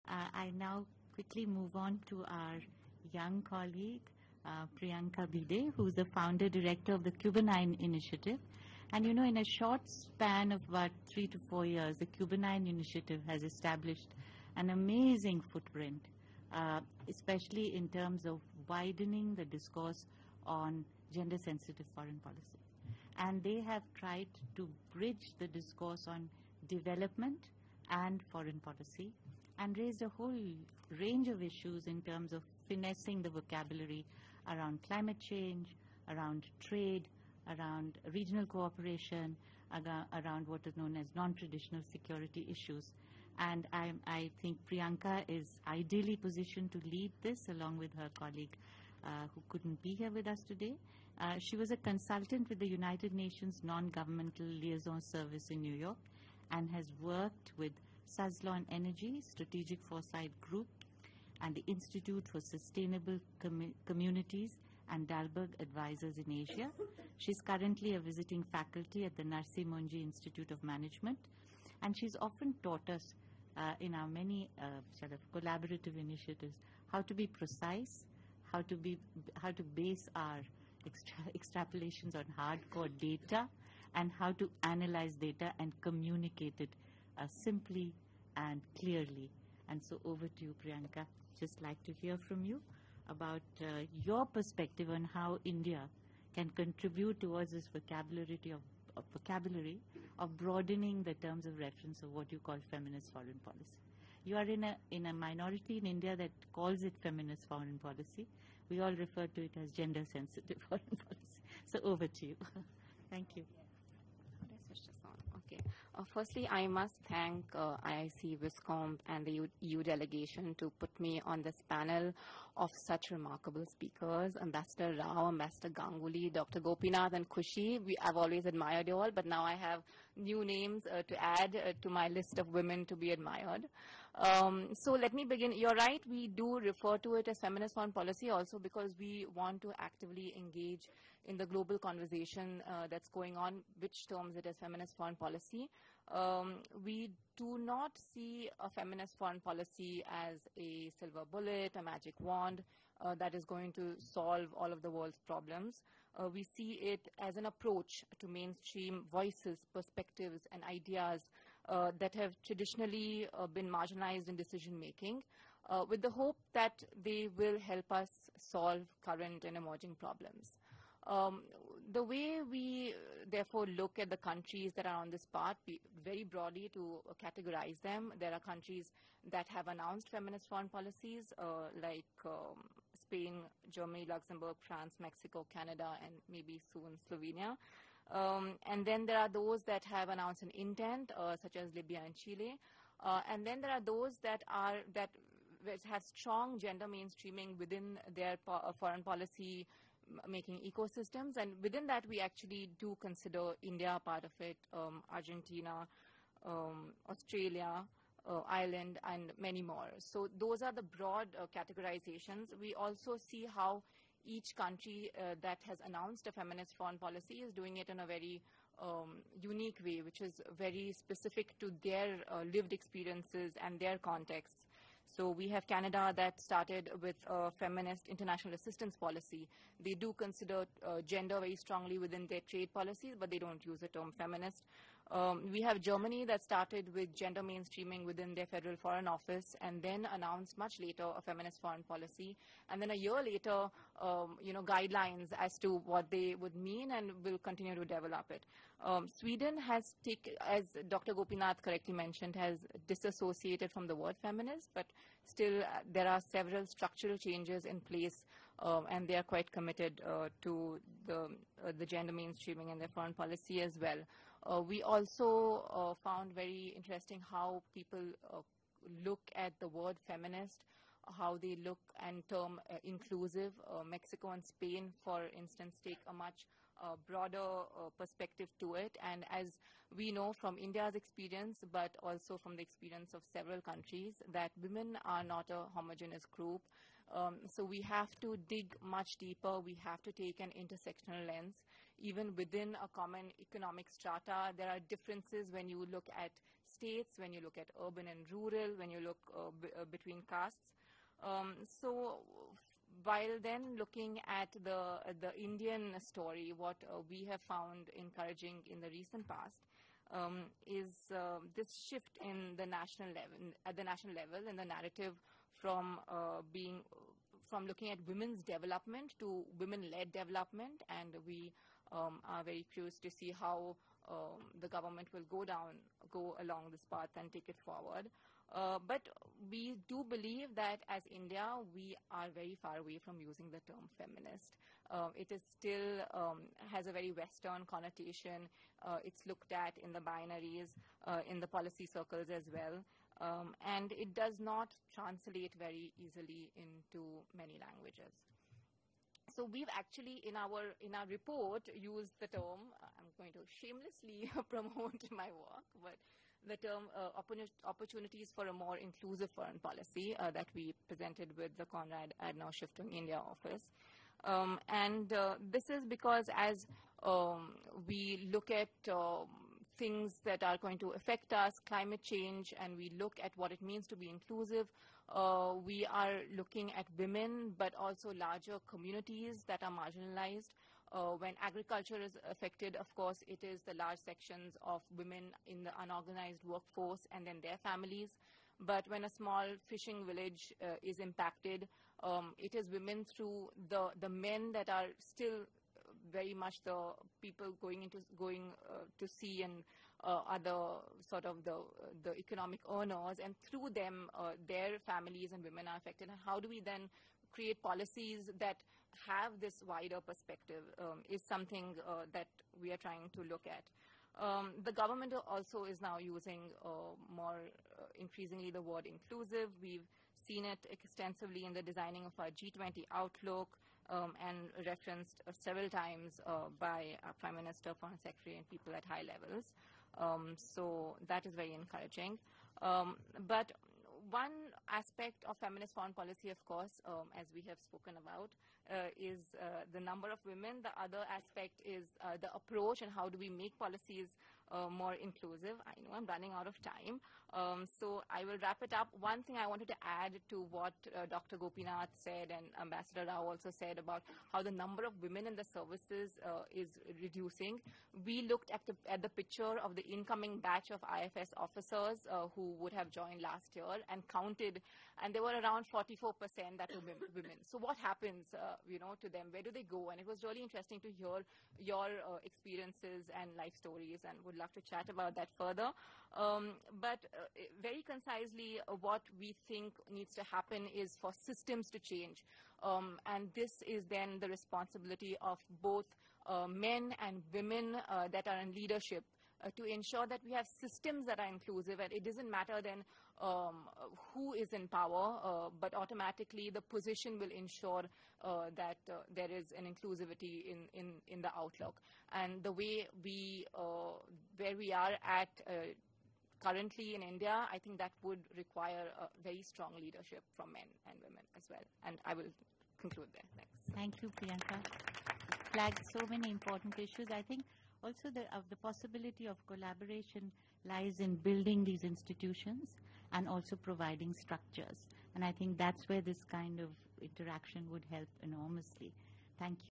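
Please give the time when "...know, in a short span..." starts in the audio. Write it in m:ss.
0:09.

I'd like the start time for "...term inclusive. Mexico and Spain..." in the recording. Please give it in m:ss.
4:32.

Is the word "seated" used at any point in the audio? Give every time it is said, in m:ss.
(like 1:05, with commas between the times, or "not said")
not said.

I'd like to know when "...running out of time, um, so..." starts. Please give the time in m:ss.
7:26.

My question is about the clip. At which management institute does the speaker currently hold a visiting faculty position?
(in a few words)
Narsee Monjee Institute of Management.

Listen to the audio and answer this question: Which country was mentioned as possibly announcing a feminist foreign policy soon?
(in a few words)
Slovenia.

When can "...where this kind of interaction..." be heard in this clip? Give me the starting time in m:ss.
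8:45.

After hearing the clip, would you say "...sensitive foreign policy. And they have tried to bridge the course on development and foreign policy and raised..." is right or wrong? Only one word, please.
wrong.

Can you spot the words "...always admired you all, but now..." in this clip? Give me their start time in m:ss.
2:08.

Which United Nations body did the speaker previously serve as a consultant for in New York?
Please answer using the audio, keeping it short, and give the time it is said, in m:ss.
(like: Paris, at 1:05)
Non-Governmental Liaison Service, at 0:53.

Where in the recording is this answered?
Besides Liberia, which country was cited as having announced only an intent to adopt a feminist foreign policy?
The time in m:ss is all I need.
3:12.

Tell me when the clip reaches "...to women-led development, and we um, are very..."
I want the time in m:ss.
5:19.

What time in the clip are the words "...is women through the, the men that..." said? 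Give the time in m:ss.
6:32.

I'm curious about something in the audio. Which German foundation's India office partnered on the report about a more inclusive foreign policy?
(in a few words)
Konrad Adenauer Stiftung.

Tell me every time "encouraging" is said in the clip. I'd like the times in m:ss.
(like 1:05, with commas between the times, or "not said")
5:07, 7:11.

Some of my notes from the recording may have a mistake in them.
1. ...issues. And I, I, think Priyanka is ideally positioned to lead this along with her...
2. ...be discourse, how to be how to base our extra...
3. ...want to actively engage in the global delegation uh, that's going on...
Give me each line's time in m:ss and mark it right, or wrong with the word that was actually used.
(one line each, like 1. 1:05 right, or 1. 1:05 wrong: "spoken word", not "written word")
1. 0:42 right
2. 1:17 wrong: "precise", not "discourse"
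3. 2:19 wrong: "conversation", not "delegation".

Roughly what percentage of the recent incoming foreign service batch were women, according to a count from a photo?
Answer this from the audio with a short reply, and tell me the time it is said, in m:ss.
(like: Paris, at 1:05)
44%, at 7:45.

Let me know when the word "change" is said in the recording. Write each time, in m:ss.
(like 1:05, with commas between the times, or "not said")
0:35, 4:17, 6:12, 8:01.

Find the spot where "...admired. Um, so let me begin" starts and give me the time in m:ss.
2:13.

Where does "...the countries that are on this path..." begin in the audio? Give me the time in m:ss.
2:54.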